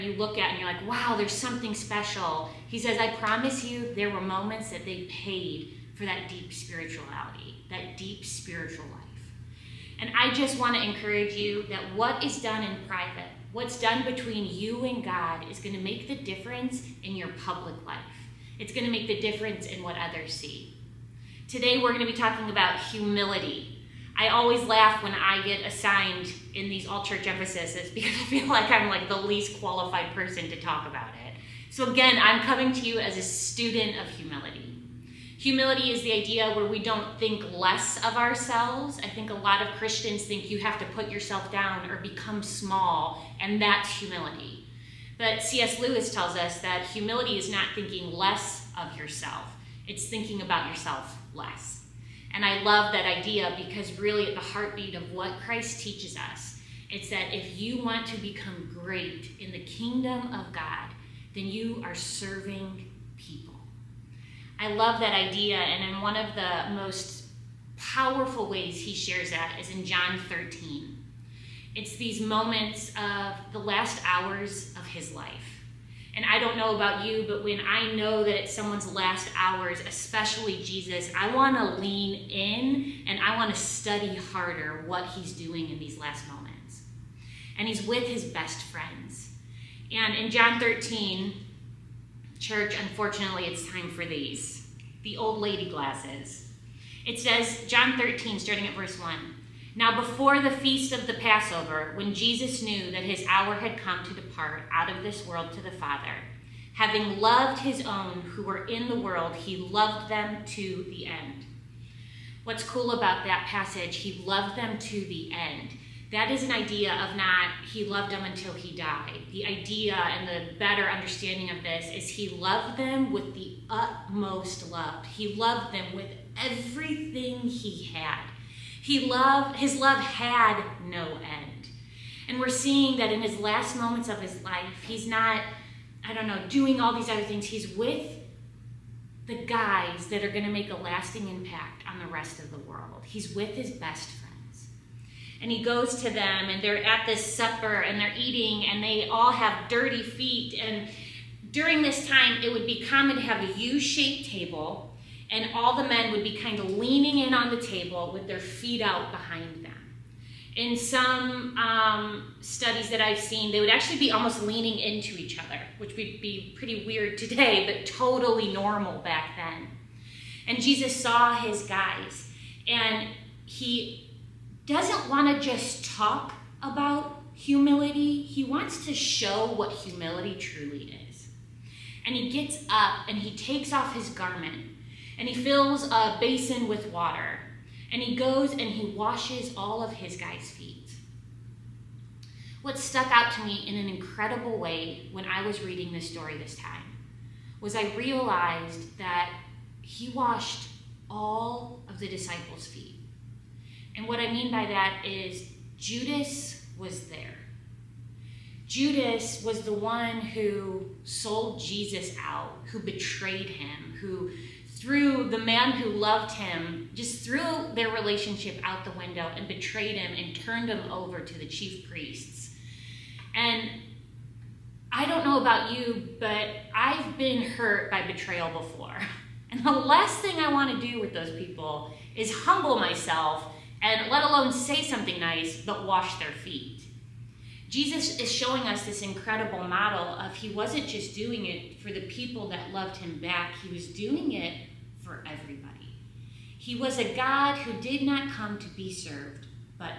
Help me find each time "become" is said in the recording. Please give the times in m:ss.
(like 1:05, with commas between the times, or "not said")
0:42, 0:58.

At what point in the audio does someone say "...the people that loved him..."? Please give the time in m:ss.
4:01.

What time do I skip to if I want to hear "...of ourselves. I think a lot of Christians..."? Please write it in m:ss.
0:37.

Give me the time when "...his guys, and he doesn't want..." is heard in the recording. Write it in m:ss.
2:51.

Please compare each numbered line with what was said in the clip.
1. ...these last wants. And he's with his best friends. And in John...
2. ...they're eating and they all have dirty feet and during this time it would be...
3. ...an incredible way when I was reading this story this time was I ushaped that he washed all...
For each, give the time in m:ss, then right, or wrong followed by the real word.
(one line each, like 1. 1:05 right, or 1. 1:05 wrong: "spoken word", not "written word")
1. 1:25 wrong: "moments", not "wants"
2. 2:27 right
3. 3:13 wrong: "realized", not "ushaped".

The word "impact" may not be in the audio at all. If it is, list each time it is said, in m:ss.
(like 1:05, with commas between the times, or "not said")
2:21.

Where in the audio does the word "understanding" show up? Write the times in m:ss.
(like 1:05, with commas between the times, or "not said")
2:00.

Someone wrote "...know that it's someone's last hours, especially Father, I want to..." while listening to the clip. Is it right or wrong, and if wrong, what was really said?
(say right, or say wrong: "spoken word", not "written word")
wrong: "Jesus", not "Father".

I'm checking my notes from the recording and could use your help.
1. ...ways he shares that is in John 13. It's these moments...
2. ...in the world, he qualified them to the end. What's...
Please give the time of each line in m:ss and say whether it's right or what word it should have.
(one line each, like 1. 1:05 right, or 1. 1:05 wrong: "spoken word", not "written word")
1. 1:08 right
2. 1:48 wrong: "loved", not "qualified".